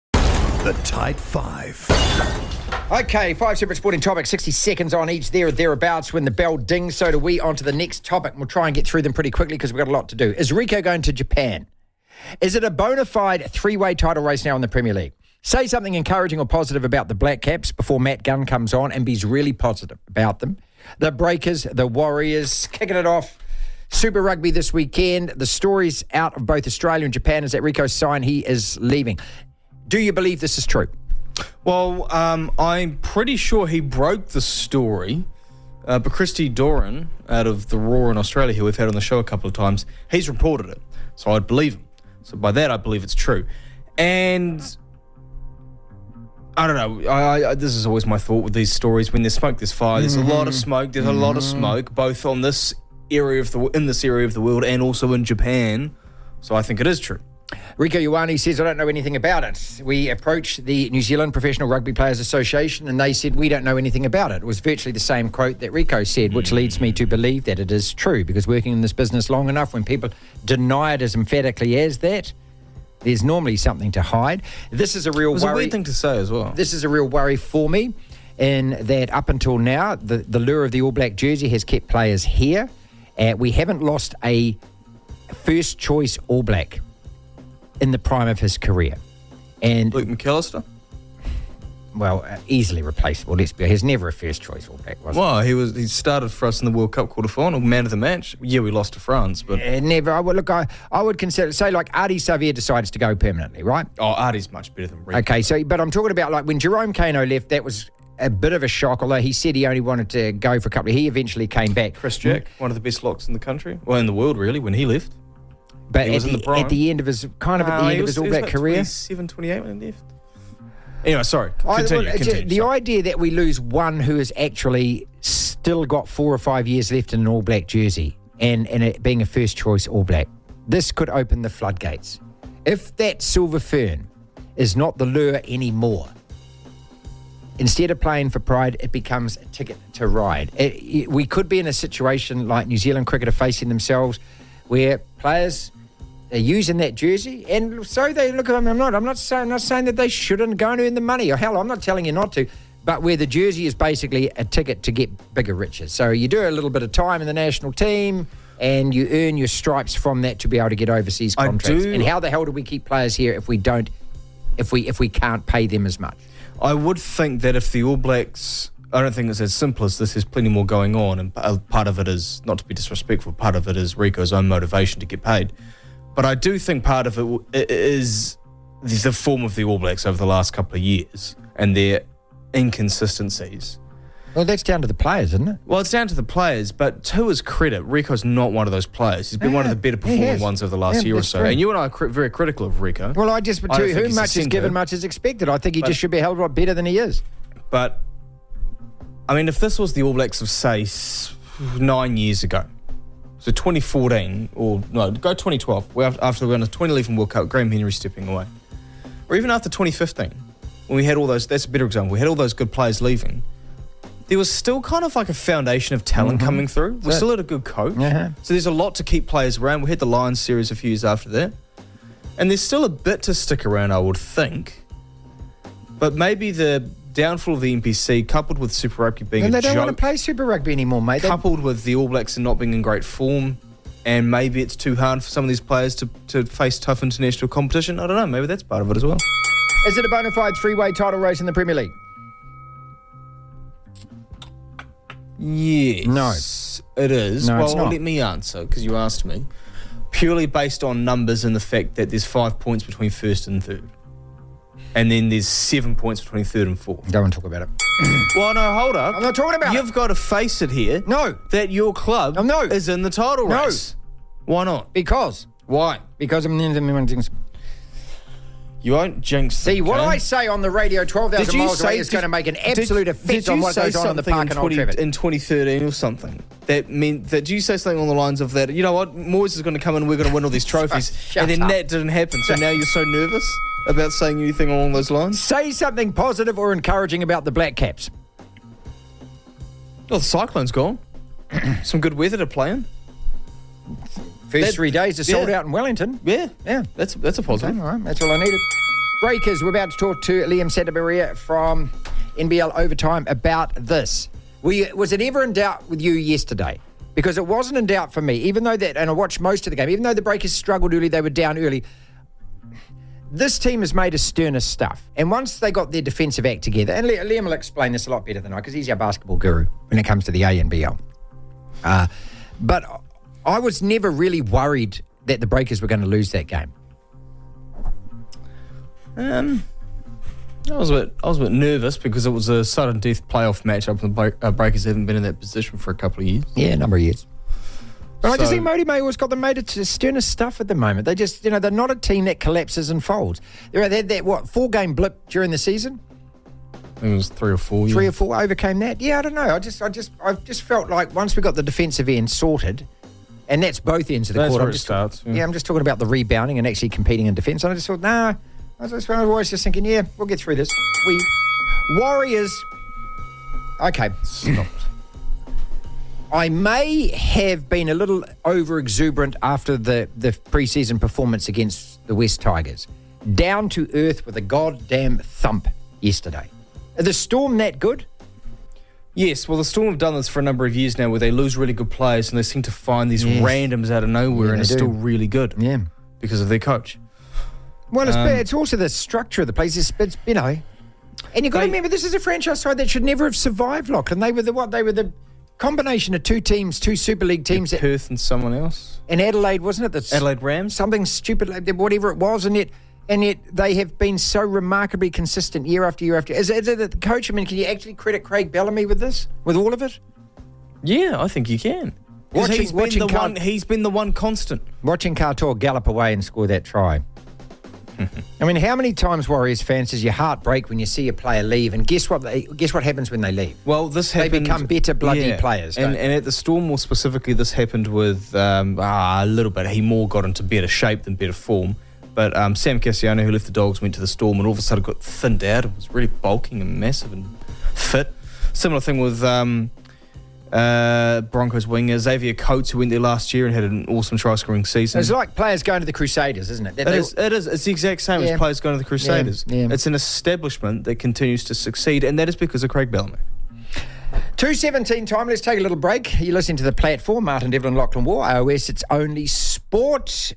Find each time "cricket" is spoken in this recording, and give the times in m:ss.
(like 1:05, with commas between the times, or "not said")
2:23.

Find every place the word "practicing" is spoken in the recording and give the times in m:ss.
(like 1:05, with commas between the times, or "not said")
not said.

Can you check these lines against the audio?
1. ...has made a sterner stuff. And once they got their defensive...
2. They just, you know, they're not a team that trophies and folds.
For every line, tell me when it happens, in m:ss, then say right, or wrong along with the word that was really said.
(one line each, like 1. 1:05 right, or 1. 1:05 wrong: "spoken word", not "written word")
1. 5:13 right
2. 5:41 wrong: "collapses", not "trophies".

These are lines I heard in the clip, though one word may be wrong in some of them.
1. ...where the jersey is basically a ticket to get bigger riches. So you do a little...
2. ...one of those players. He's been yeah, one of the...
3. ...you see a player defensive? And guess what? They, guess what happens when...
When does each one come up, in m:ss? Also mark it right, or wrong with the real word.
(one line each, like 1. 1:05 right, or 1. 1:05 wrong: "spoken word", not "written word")
1. 2:33 right
2. 3:08 right
3. 7:00 wrong: "leave", not "defensive".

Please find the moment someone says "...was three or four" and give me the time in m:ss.
5:47.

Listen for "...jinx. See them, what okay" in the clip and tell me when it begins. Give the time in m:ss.
4:29.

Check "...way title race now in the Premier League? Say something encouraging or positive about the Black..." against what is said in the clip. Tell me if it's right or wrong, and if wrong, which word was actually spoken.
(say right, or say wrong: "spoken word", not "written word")
right.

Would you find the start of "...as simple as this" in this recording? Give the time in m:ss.
2:49.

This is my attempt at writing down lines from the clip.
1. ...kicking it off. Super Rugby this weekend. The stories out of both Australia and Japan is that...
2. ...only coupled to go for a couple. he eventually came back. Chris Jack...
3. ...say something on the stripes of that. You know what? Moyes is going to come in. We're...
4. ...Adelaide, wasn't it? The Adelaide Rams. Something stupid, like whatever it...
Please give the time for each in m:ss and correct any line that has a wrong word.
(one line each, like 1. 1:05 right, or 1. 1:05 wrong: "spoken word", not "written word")
1. 0:22 right
2. 1:49 wrong: "wanted", not "coupled"
3. 4:37 wrong: "lines", not "stripes"
4. 6:39 right.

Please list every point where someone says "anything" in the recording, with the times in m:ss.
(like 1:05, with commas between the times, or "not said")
0:58, 1:03, 4:44.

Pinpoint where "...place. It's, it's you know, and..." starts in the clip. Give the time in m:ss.
6:29.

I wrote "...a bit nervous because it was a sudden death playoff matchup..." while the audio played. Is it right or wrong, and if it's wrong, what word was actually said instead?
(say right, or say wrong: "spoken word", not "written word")
right.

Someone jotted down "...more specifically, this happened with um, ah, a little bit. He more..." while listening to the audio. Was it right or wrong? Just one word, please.
right.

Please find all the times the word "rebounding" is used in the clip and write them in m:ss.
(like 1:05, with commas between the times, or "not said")
5:56.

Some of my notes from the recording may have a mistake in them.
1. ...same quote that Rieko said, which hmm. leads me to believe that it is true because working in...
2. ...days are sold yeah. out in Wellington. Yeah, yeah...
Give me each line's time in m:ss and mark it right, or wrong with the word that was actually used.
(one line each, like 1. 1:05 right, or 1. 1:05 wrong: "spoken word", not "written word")
1. 1:04 right
2. 4:54 right.